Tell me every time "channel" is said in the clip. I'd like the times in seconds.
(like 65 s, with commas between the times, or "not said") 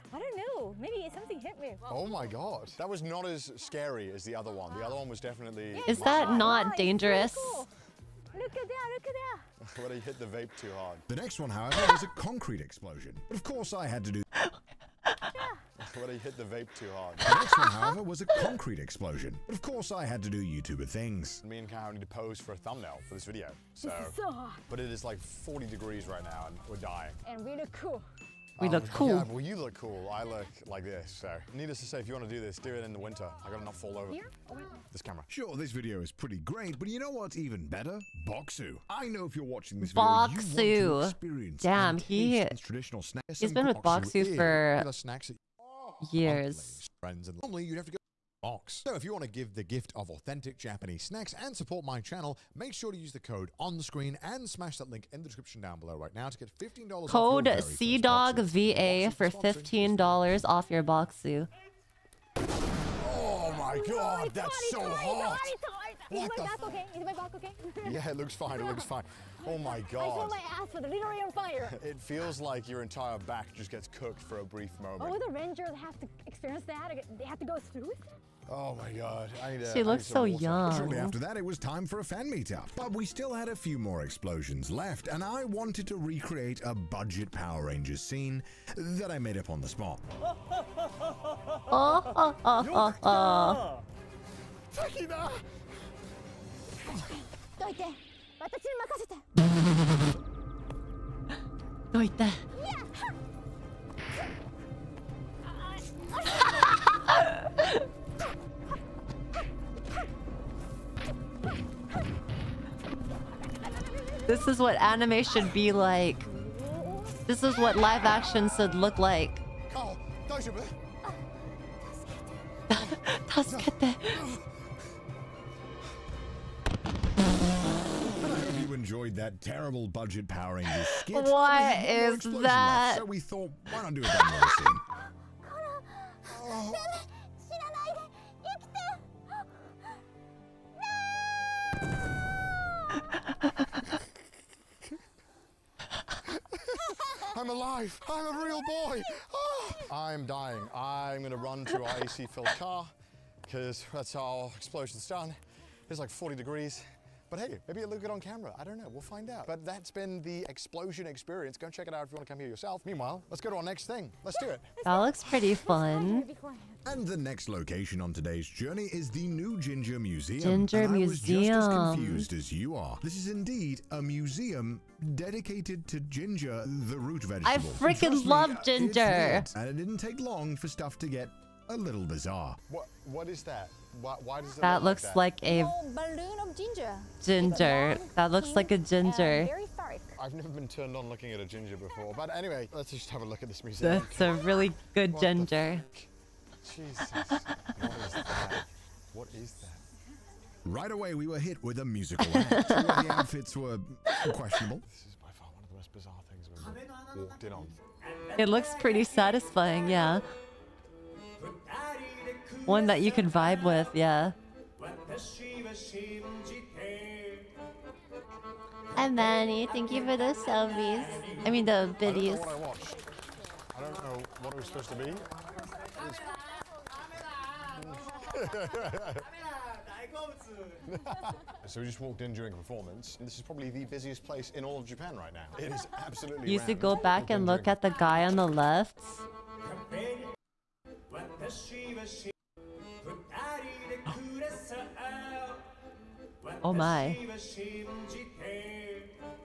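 51 s.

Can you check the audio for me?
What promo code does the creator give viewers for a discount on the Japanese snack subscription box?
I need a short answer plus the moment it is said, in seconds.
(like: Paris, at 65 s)
CDAWGVA, at 57 s.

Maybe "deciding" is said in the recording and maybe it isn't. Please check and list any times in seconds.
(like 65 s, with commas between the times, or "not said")
not said.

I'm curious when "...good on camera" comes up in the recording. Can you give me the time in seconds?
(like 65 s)
158 s.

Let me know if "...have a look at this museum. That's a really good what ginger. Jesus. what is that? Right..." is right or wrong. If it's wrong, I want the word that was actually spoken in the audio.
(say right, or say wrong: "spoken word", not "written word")
right.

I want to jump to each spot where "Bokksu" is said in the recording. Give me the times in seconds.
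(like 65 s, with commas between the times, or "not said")
38 s, 43 s, 60 s.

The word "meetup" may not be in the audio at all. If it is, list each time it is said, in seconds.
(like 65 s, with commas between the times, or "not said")
82 s.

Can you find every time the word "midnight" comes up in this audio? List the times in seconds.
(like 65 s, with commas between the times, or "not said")
not said.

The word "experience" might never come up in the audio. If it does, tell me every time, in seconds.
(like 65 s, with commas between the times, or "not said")
41 s, 76 s, 161 s.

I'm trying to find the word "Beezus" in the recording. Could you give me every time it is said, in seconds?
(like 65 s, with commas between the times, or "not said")
not said.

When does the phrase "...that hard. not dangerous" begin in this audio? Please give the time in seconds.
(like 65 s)
5 s.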